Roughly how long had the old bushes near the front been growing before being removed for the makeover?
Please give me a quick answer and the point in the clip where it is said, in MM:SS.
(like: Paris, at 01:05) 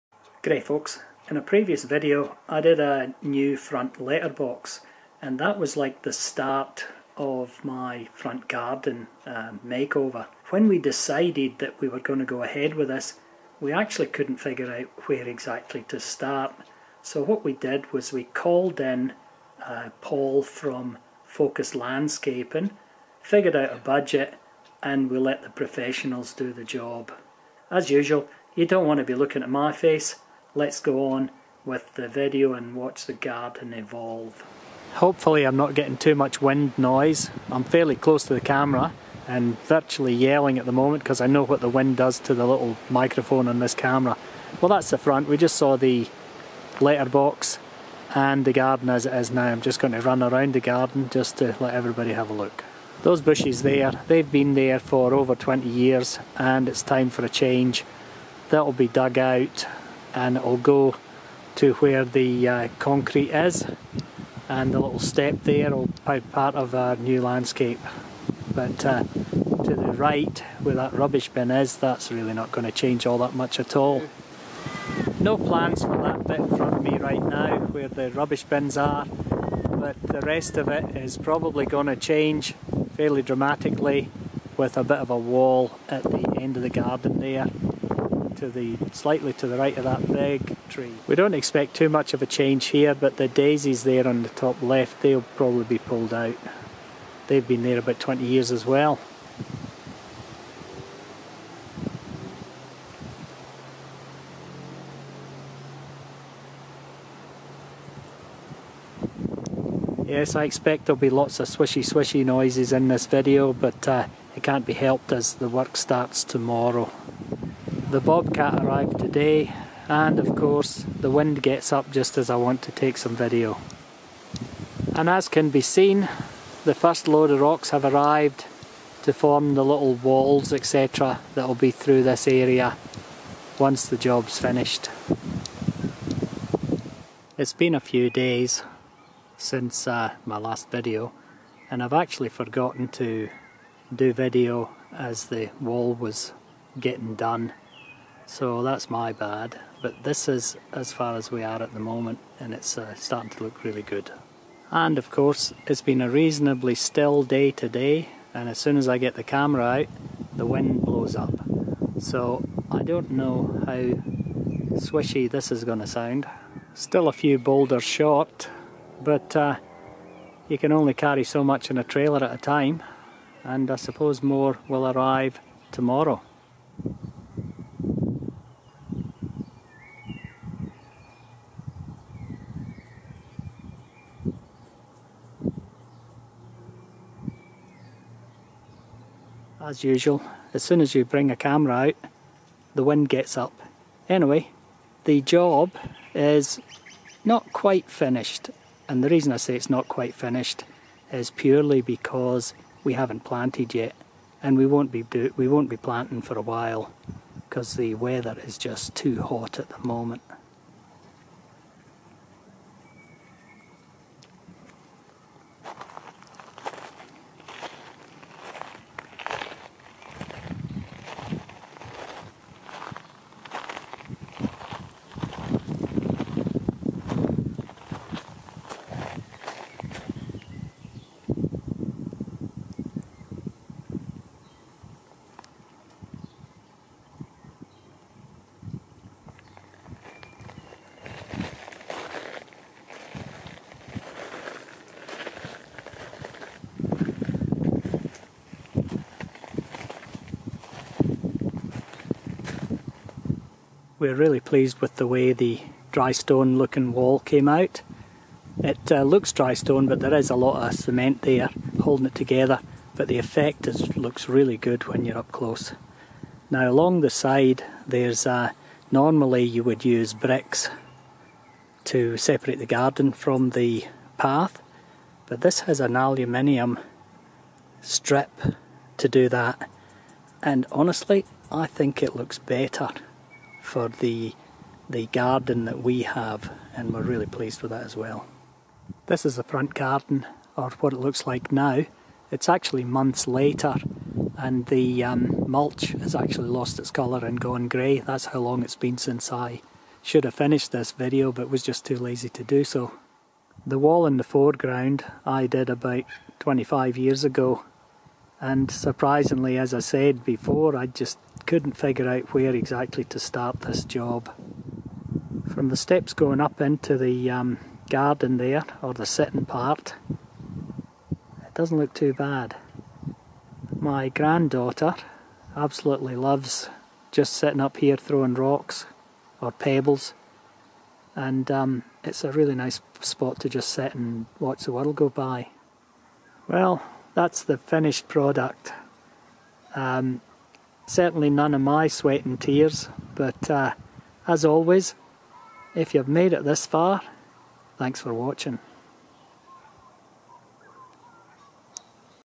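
over 20 years, at 00:55.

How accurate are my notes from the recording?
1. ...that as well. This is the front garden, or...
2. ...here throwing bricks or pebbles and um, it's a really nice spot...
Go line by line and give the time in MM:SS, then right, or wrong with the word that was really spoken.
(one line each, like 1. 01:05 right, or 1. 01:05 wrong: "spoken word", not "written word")
1. 04:47 right
2. 05:27 wrong: "rocks", not "bricks".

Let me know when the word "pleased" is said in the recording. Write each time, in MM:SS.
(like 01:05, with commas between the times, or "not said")
04:14, 04:47.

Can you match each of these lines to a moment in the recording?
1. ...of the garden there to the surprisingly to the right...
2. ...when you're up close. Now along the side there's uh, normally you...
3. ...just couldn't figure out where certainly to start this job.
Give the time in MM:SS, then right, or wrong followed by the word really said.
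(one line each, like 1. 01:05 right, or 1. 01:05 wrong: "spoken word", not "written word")
1. 01:26 wrong: "slightly", not "surprisingly"
2. 04:24 right
3. 05:10 wrong: "exactly", not "certainly".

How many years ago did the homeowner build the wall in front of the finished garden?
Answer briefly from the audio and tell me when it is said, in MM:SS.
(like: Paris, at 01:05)
about 25, at 05:05.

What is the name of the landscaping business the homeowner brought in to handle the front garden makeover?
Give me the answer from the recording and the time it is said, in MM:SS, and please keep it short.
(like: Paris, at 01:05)
Focus Landscaping, at 00:21.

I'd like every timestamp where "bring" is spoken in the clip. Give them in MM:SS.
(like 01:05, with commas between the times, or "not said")
03:11.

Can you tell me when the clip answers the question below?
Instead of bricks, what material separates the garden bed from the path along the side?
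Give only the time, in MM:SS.
04:35.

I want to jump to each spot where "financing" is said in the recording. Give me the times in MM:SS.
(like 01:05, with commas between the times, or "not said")
not said.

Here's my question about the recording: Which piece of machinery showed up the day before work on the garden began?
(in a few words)
Bobcat.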